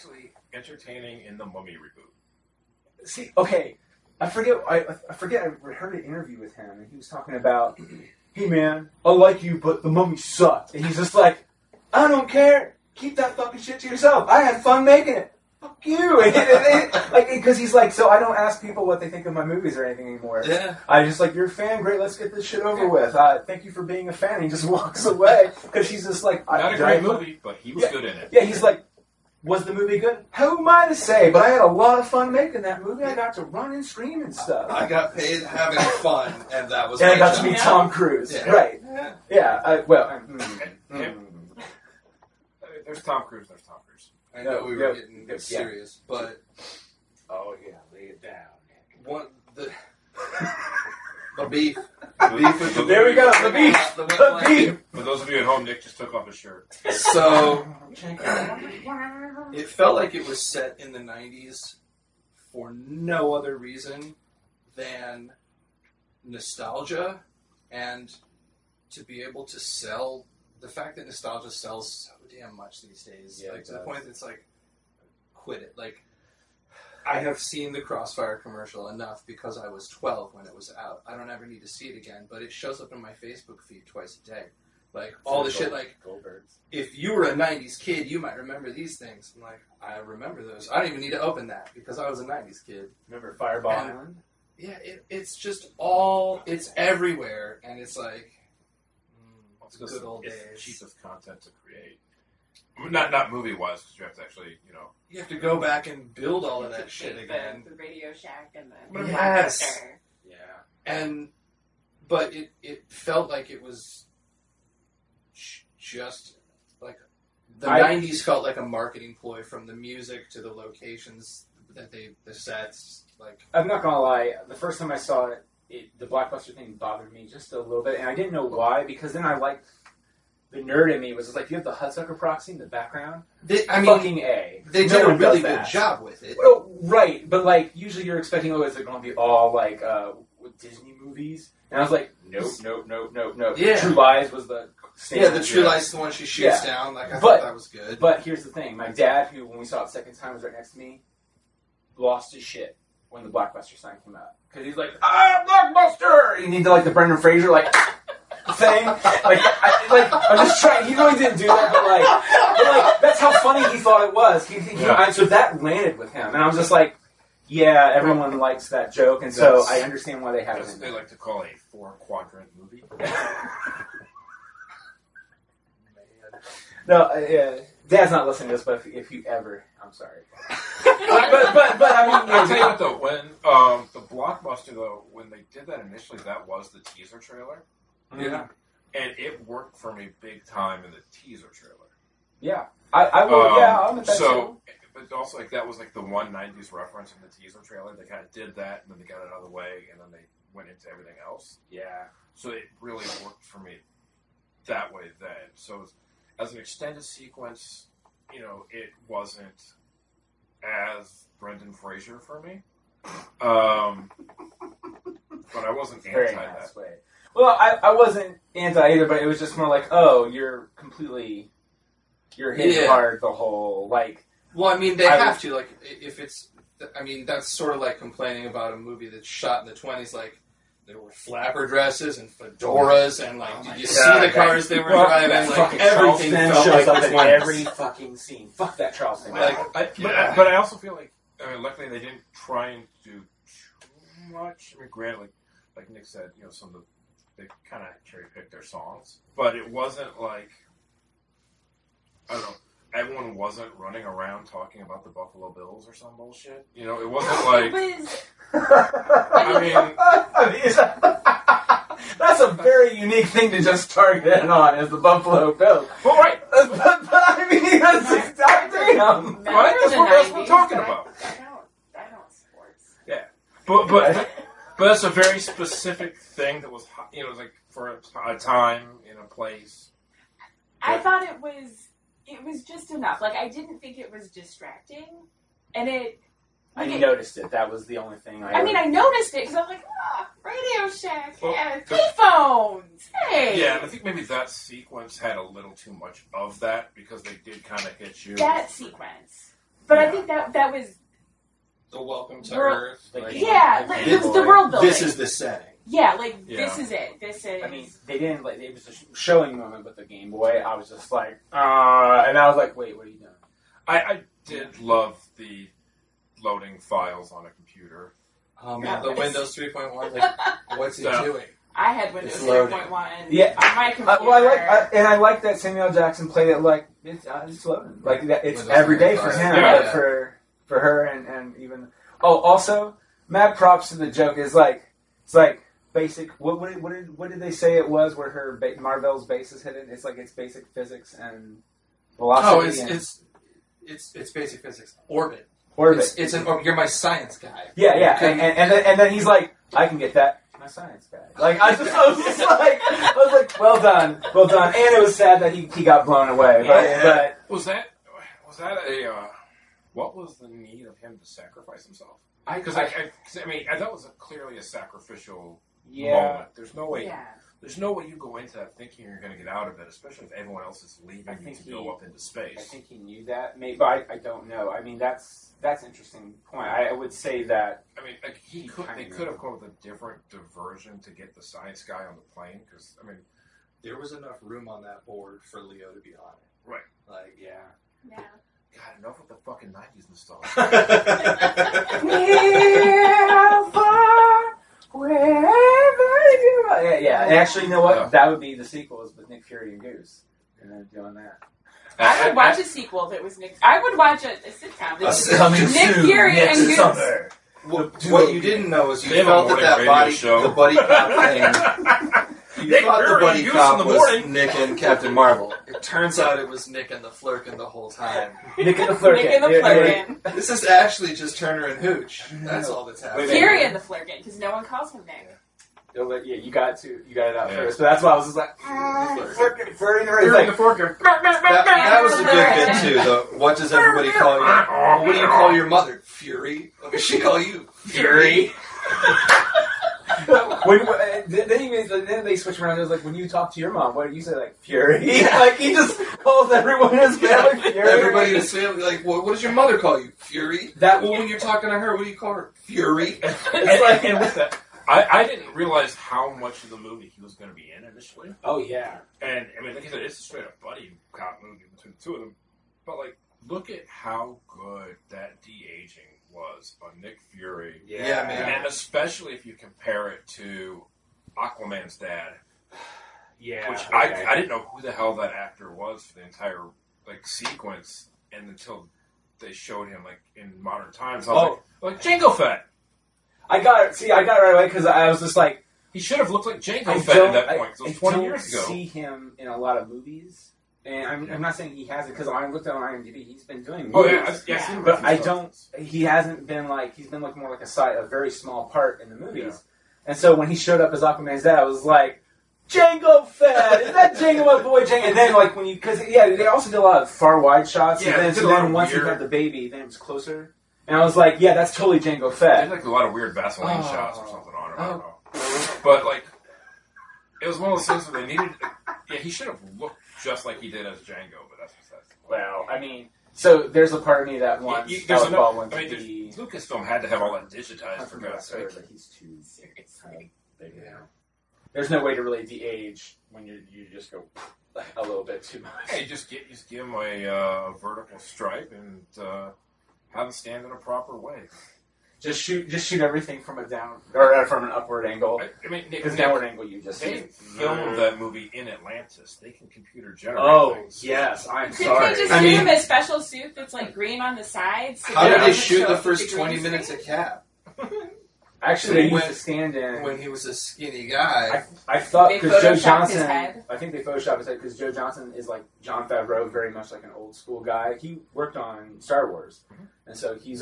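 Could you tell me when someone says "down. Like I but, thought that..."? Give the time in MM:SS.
02:26.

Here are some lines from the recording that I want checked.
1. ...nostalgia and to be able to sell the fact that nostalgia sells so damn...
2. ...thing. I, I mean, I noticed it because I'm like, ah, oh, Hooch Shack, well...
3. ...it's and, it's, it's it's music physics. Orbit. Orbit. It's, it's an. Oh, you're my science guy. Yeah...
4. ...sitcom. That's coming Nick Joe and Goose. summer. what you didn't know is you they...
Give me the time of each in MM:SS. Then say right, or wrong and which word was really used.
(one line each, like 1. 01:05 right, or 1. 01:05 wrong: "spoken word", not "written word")
1. 01:06 right
2. 04:48 wrong: "Radio", not "Hooch"
3. 05:42 wrong: "basic", not "music"
4. 06:44 wrong: "Fury", not "Joe".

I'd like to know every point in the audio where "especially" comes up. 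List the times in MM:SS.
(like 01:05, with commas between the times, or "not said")
06:09, 07:48.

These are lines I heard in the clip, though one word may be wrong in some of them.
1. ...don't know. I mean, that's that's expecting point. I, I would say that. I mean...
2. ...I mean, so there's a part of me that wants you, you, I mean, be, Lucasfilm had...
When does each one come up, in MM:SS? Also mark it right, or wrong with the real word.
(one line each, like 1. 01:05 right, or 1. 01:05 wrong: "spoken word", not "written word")
1. 06:14 wrong: "interesting", not "expecting"
2. 08:42 right.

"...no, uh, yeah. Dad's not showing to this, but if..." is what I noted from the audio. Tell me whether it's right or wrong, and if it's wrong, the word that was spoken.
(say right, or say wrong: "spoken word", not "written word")
wrong: "listening", not "showing".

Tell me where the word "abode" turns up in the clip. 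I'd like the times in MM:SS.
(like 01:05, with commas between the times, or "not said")
not said.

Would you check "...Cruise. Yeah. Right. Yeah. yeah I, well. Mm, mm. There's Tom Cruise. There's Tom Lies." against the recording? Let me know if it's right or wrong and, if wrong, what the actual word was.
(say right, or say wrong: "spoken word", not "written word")
wrong: "Cruise", not "Lies".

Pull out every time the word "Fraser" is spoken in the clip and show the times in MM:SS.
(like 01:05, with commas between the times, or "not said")
02:37, 03:31.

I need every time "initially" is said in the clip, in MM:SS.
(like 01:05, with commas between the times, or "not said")
03:05, 07:37.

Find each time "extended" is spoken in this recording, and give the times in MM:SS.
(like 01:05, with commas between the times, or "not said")
03:26.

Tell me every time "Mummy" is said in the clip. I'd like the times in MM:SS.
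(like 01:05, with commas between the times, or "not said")
00:01, 00:09.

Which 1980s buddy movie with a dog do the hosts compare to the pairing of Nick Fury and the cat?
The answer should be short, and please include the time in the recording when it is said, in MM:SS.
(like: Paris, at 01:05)
Turner and Hooch, at 07:01.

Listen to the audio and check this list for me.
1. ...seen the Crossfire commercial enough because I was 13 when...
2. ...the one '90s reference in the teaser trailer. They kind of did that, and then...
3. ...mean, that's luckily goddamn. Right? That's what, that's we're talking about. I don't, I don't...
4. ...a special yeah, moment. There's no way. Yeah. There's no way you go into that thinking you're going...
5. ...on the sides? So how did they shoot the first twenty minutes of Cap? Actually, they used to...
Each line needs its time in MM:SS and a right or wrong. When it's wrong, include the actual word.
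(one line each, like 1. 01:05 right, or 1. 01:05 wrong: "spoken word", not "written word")
1. 01:17 wrong: "12", not "13"
2. 03:15 right
3. 04:27 wrong: "exactly", not "luckily"
4. 06:04 wrong: "sacrificial", not "special"
5. 09:14 right.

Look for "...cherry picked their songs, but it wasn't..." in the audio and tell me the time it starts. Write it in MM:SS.
04:08.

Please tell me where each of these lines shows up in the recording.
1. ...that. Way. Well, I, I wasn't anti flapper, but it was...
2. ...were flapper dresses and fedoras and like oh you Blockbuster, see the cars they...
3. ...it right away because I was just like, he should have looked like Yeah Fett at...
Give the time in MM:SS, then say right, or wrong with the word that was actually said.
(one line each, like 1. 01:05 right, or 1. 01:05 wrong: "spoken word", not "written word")
1. 03:36 wrong: "either", not "flapper"
2. 03:50 wrong: "God", not "Blockbuster"
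3. 08:04 wrong: "Jango", not "Yeah".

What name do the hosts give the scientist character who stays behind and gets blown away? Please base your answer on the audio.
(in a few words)
Leo.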